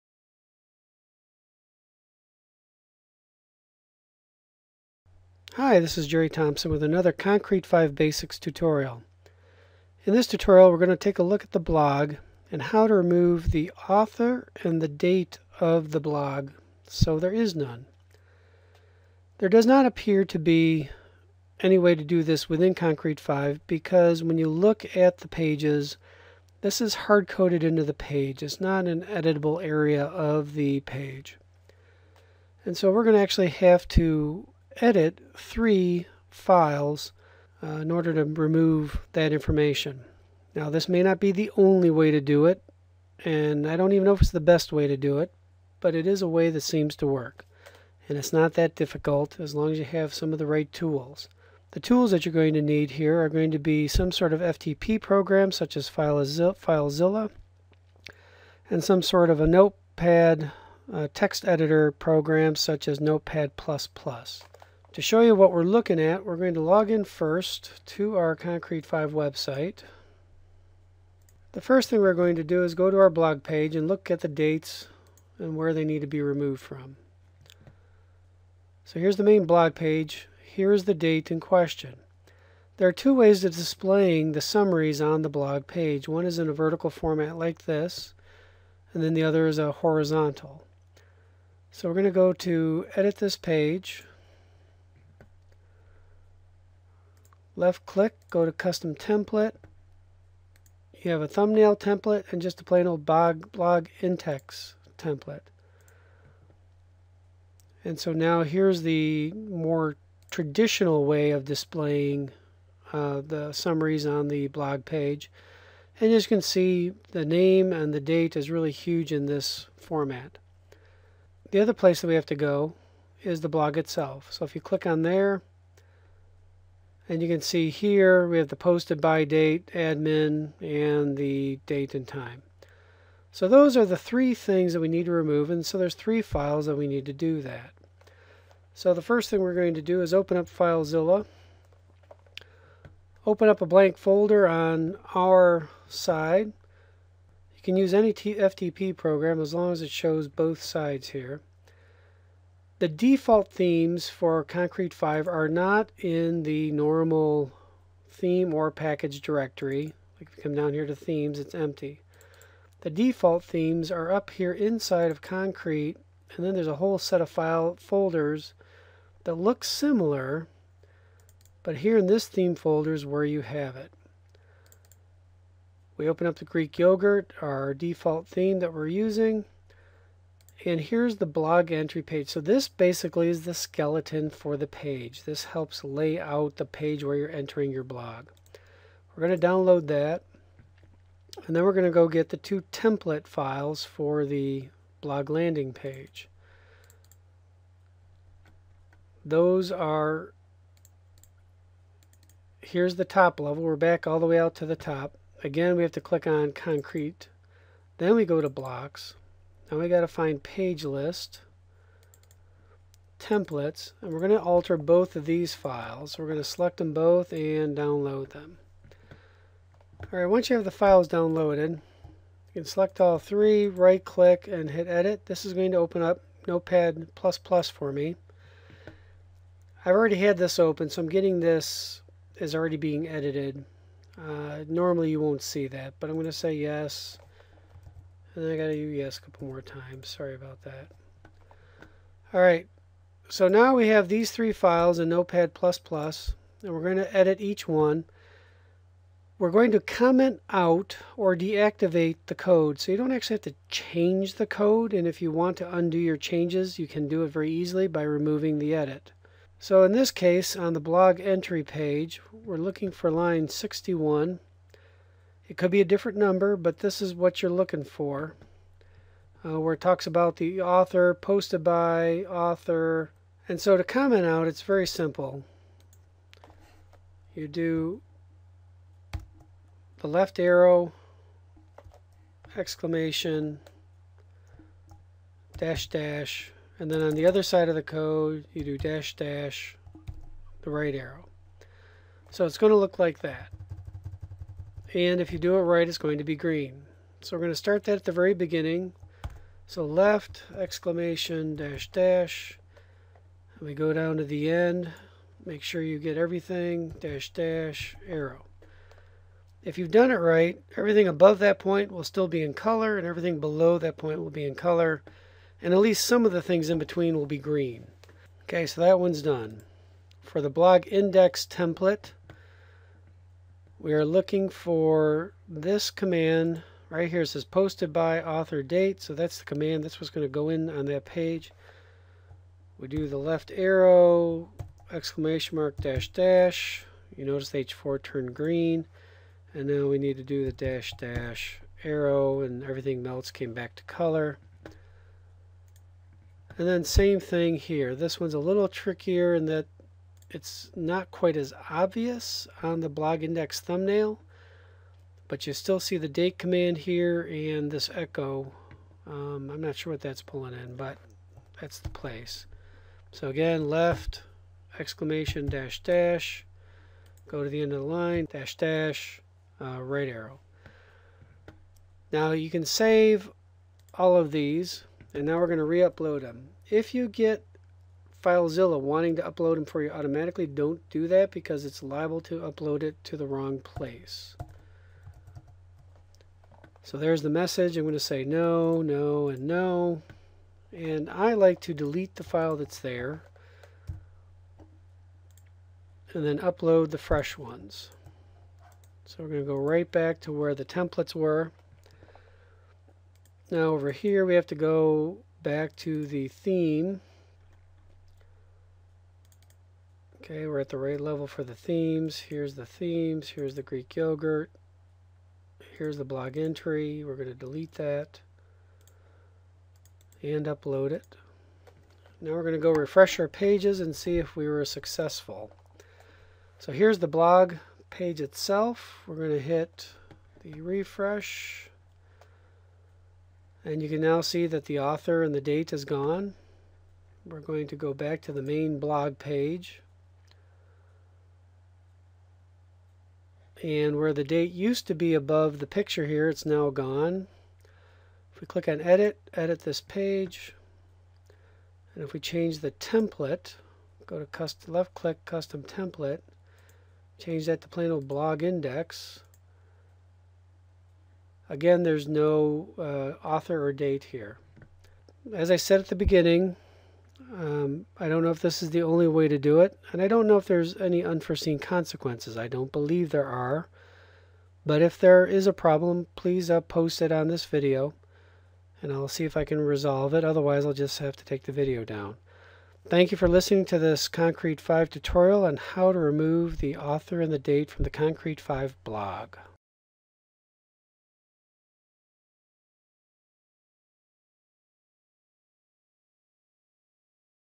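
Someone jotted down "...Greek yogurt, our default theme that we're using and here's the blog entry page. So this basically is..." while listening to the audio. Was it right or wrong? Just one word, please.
right.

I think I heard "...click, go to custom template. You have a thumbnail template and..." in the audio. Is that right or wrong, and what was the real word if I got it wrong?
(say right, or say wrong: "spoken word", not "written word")
right.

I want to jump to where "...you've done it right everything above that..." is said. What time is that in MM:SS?
05:09.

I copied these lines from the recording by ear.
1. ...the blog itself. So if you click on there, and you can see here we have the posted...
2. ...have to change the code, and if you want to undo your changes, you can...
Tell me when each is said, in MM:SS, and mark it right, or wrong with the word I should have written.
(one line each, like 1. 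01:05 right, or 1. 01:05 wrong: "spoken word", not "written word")
1. 02:03 right
2. 04:13 right.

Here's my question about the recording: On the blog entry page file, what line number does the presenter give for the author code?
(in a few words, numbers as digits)
61.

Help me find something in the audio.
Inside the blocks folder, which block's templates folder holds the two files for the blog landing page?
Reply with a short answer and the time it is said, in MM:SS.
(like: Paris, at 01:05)
page list, at 03:30.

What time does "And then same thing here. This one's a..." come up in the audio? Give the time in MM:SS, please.
05:46.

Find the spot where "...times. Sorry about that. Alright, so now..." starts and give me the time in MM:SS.
03:59.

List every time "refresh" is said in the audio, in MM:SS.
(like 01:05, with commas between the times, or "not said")
07:02, 07:10.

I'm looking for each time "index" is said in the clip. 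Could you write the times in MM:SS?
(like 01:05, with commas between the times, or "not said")
05:20, 05:53, 07:38.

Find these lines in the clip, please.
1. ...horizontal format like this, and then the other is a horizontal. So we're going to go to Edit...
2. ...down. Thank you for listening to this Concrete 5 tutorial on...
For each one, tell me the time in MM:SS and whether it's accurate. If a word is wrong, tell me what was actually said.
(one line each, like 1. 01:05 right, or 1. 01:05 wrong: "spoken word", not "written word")
1. 01:26 wrong: "vertical", not "horizontal"
2. 08:01 right.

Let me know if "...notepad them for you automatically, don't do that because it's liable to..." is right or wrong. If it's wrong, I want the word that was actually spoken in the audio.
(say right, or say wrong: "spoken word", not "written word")
wrong: "upload", not "notepad".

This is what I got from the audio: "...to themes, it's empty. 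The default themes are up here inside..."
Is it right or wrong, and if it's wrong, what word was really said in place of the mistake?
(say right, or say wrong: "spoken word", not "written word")
right.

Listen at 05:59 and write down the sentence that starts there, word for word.
Um, I'm not sure what that's pulling in, but that's the place.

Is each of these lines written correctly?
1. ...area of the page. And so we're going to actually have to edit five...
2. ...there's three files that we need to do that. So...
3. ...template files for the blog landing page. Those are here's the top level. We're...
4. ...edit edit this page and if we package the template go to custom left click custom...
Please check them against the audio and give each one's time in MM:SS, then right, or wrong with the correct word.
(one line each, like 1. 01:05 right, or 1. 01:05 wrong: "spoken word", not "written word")
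1. 00:29 wrong: "three", not "five"
2. 02:15 right
3. 03:12 right
4. 07:28 wrong: "change", not "package".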